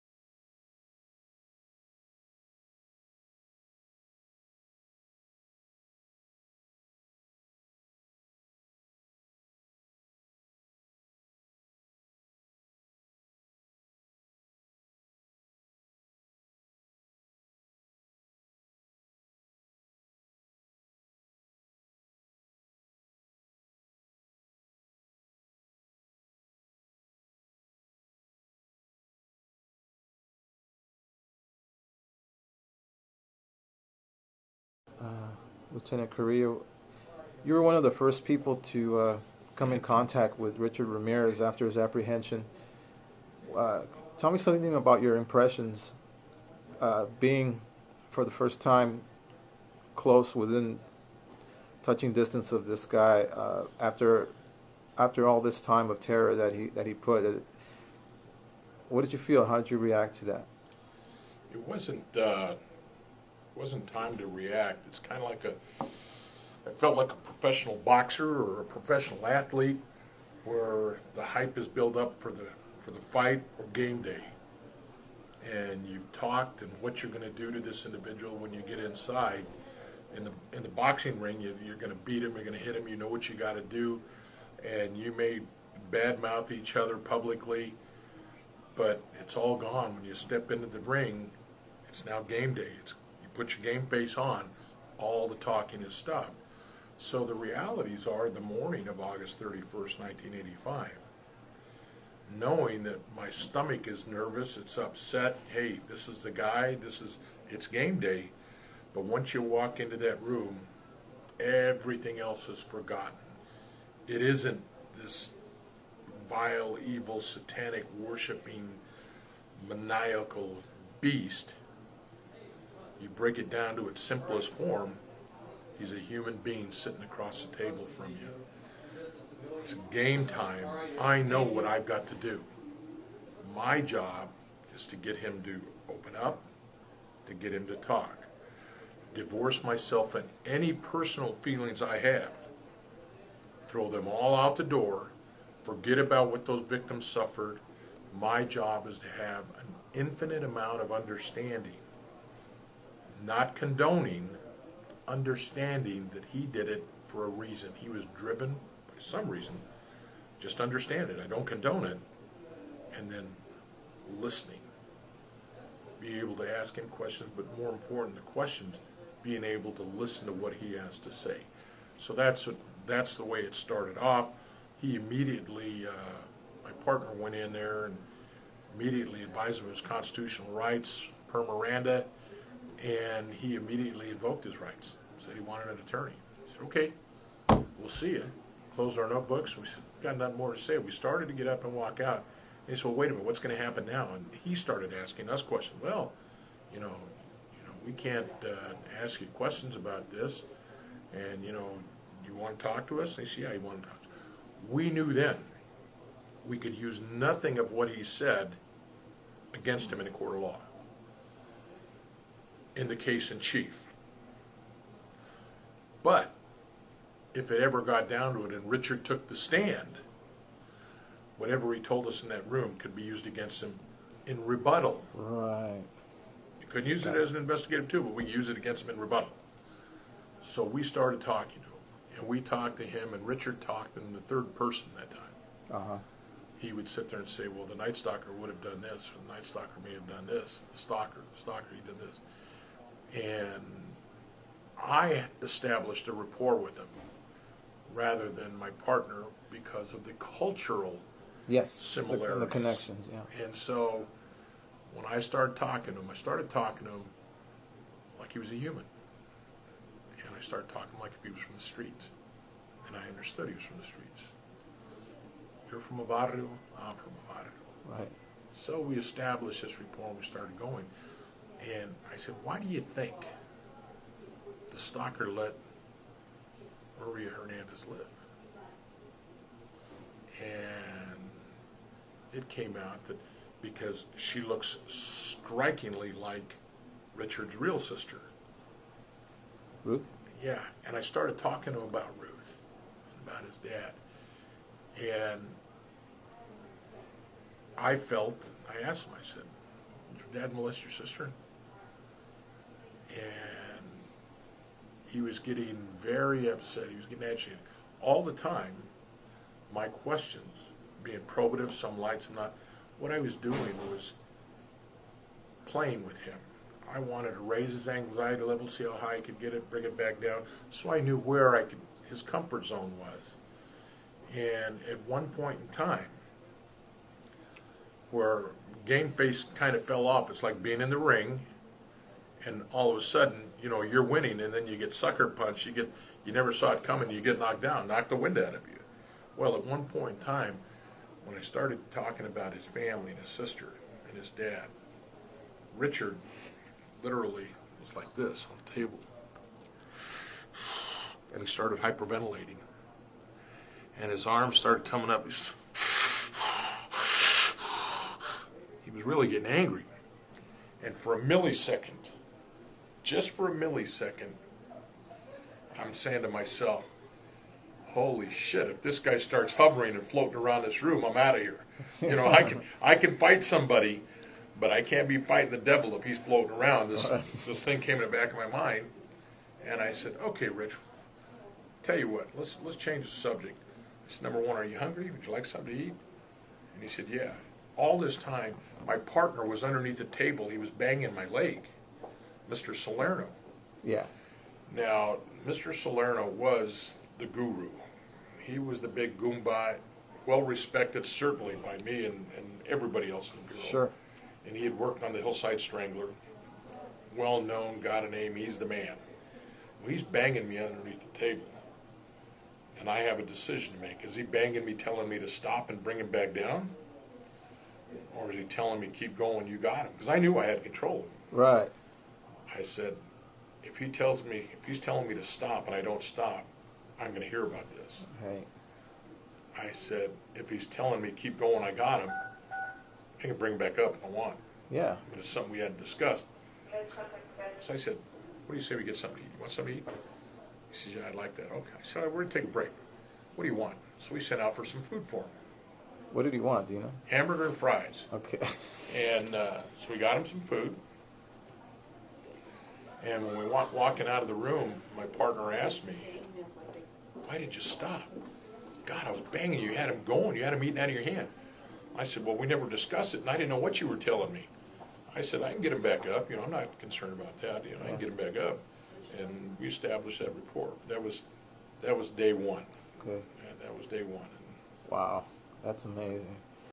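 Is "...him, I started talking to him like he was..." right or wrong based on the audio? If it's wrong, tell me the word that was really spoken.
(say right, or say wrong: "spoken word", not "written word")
right.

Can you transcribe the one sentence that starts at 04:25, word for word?
You're from a barrio, I'm from a barrio.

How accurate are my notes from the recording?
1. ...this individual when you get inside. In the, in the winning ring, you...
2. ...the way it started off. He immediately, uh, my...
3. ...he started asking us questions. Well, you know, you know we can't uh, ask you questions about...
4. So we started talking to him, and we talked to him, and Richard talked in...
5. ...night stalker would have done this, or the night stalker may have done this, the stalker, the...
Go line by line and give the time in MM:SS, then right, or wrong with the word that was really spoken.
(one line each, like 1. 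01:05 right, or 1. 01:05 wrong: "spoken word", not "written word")
1. 01:17 wrong: "boxing", not "winning"
2. 02:53 right
3. 03:14 right
4. 03:50 right
5. 03:57 right.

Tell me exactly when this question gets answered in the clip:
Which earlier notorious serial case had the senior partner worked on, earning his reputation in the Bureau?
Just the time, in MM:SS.
06:45.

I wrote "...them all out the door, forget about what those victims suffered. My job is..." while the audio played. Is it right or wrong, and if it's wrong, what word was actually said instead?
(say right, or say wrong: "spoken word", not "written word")
right.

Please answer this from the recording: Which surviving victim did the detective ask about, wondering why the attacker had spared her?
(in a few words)
Maria Hernandez.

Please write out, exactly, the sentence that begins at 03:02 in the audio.
And he immediately invoked his rights, said he wanted an attorney.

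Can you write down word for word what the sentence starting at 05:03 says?
and he was getting very upset.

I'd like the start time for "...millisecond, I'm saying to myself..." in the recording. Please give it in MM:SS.
06:03.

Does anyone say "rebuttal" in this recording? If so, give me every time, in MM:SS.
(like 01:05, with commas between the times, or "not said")
03:44, 03:48.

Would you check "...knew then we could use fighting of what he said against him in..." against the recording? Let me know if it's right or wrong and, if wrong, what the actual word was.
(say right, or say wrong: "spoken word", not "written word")
wrong: "nothing", not "fighting".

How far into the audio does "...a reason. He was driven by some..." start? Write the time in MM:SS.
02:37.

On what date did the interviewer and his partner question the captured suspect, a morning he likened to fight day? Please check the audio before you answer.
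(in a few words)
August 31st, 1985.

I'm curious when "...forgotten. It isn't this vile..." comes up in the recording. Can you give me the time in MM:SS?
01:52.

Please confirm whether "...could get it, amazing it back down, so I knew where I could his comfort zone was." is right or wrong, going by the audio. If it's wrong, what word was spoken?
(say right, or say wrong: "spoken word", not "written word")
wrong: "bring", not "amazing".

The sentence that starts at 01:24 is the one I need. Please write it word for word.
And you may badmouth each other publicly, but it's all gone.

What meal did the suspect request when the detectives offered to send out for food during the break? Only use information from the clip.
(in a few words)
Hamburger and fries.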